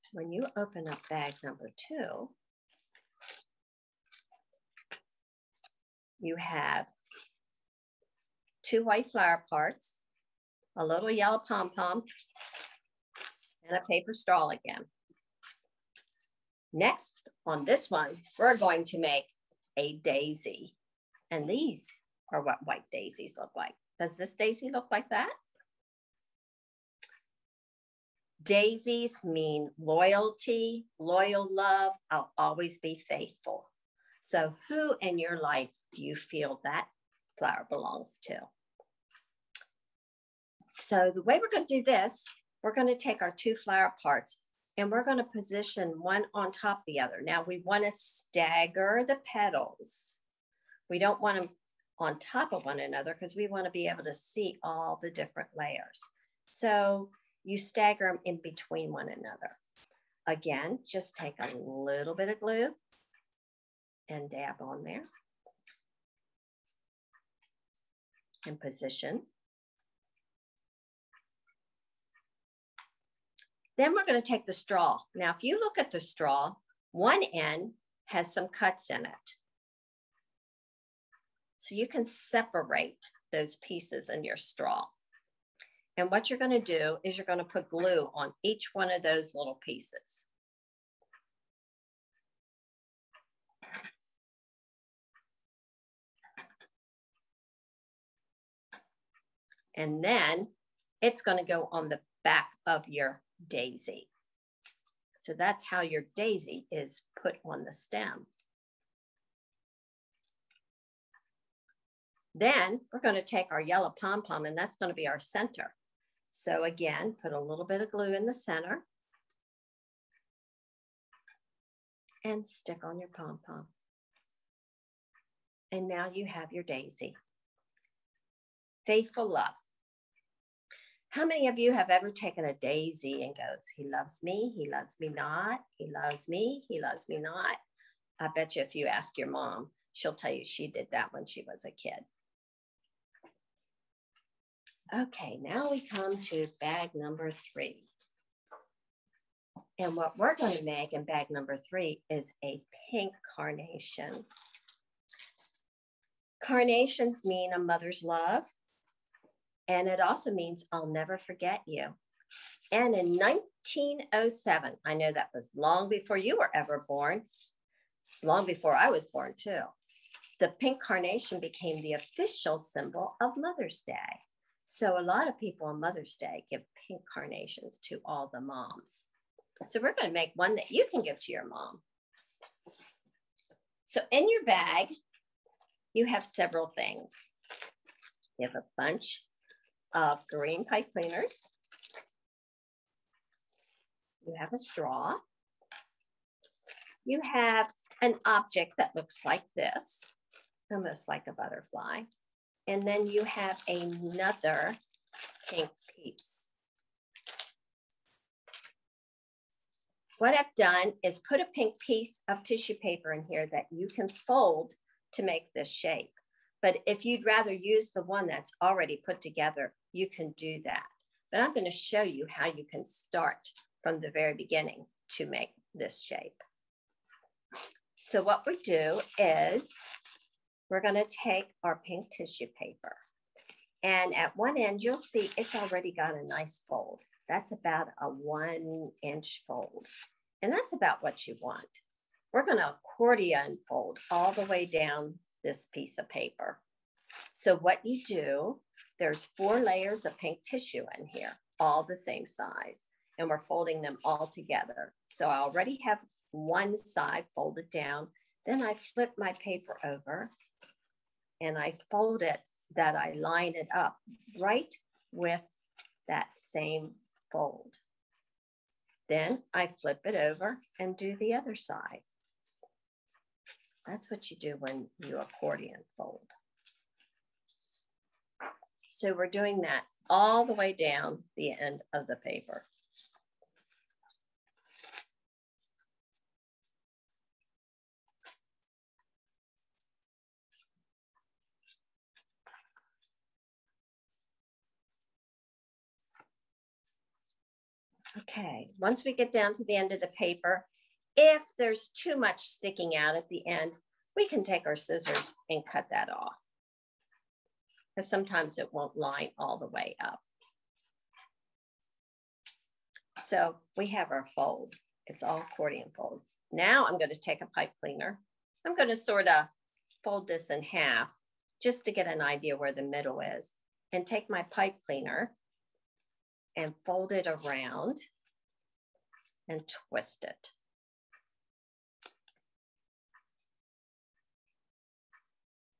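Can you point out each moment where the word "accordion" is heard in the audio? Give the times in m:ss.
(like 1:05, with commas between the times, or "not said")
4:02, 4:35, 5:15.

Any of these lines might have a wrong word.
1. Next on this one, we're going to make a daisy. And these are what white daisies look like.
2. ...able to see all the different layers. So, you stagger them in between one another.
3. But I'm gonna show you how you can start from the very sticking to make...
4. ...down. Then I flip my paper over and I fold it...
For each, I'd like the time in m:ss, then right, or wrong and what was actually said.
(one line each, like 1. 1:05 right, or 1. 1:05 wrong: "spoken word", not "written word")
1. 0:16 right
2. 0:53 right
3. 3:41 wrong: "beginning", not "sticking"
4. 4:17 right.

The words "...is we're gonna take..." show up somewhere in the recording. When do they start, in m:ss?
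3:49.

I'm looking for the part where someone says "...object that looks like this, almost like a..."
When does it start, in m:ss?
3:18.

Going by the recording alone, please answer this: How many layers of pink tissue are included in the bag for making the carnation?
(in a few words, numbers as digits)
4.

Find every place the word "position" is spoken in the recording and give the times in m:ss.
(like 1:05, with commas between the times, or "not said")
0:45, 1:08.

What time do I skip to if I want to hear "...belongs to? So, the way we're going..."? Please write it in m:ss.
0:37.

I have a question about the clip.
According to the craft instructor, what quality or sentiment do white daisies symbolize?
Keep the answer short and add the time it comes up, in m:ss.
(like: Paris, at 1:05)
Loyalty, at 0:29.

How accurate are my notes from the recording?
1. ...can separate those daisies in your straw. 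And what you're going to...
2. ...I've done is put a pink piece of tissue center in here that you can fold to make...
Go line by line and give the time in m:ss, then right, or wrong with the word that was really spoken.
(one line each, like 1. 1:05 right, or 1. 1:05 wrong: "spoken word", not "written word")
1. 1:21 wrong: "pieces", not "daisies"
2. 3:30 wrong: "paper", not "center".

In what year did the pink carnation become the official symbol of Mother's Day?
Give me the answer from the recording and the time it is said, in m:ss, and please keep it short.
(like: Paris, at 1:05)
1907, at 2:43.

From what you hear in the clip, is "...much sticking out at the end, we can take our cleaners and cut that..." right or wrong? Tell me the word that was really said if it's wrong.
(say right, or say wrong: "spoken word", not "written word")
wrong: "scissors", not "cleaners".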